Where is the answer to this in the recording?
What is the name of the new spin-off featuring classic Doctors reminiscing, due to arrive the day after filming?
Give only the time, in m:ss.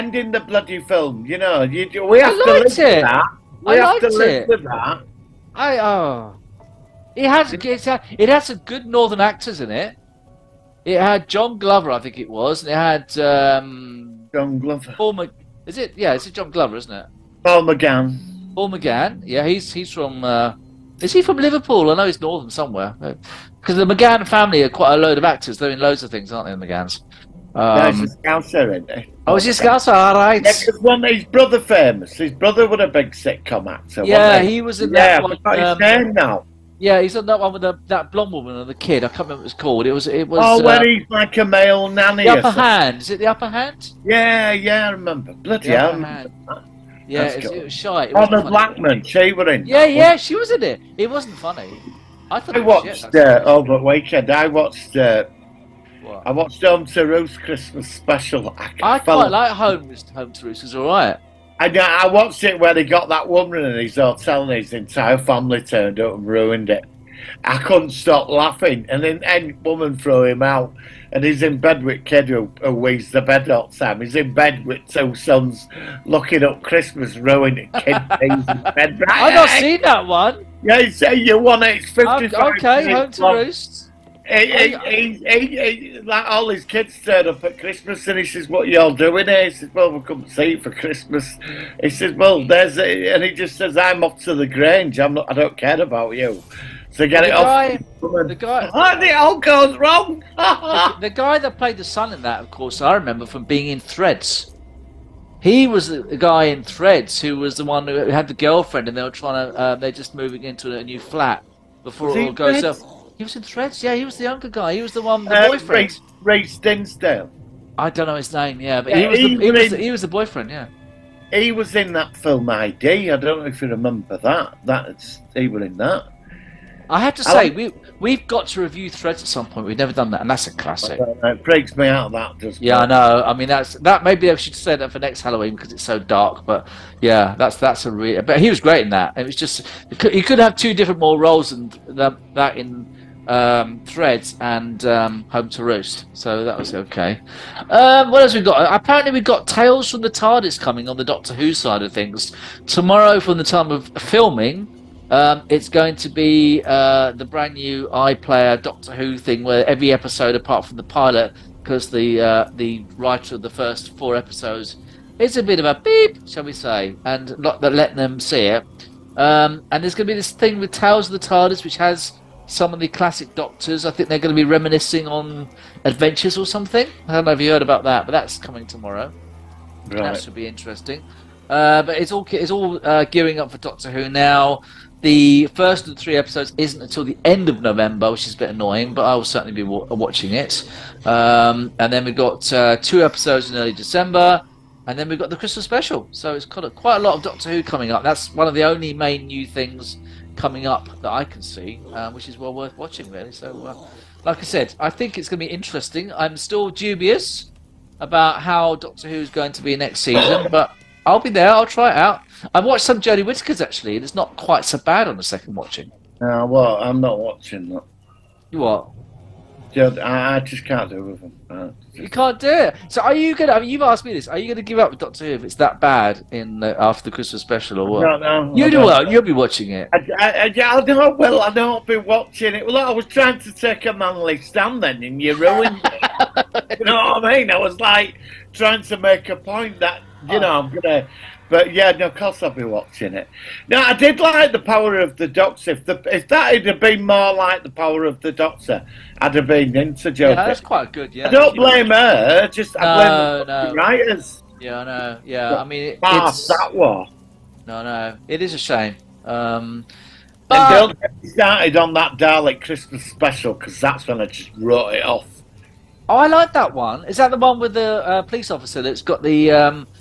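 2:29.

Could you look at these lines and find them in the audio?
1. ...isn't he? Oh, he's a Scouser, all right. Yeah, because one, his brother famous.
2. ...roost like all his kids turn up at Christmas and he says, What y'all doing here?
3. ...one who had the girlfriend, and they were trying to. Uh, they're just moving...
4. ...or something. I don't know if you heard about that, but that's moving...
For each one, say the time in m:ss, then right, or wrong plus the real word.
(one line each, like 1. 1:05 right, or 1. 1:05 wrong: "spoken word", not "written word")
1. 0:28 right
2. 1:23 right
3. 1:47 right
4. 2:56 wrong: "coming", not "moving".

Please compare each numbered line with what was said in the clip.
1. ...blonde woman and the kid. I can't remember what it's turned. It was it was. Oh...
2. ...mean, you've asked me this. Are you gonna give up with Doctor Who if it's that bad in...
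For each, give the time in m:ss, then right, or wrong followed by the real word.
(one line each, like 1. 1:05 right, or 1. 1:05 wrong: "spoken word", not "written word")
1. 0:38 wrong: "called", not "turned"
2. 3:43 right.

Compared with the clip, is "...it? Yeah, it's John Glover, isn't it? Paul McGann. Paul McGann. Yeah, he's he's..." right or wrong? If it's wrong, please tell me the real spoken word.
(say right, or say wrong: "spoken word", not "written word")
right.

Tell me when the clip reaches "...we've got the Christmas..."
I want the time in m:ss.
3:15.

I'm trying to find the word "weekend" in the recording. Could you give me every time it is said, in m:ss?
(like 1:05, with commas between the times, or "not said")
0:53.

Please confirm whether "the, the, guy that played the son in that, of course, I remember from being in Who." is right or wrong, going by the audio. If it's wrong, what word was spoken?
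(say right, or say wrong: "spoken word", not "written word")
wrong: "Threads", not "Who".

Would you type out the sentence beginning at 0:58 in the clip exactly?
I, I quite like Home Home to Roost.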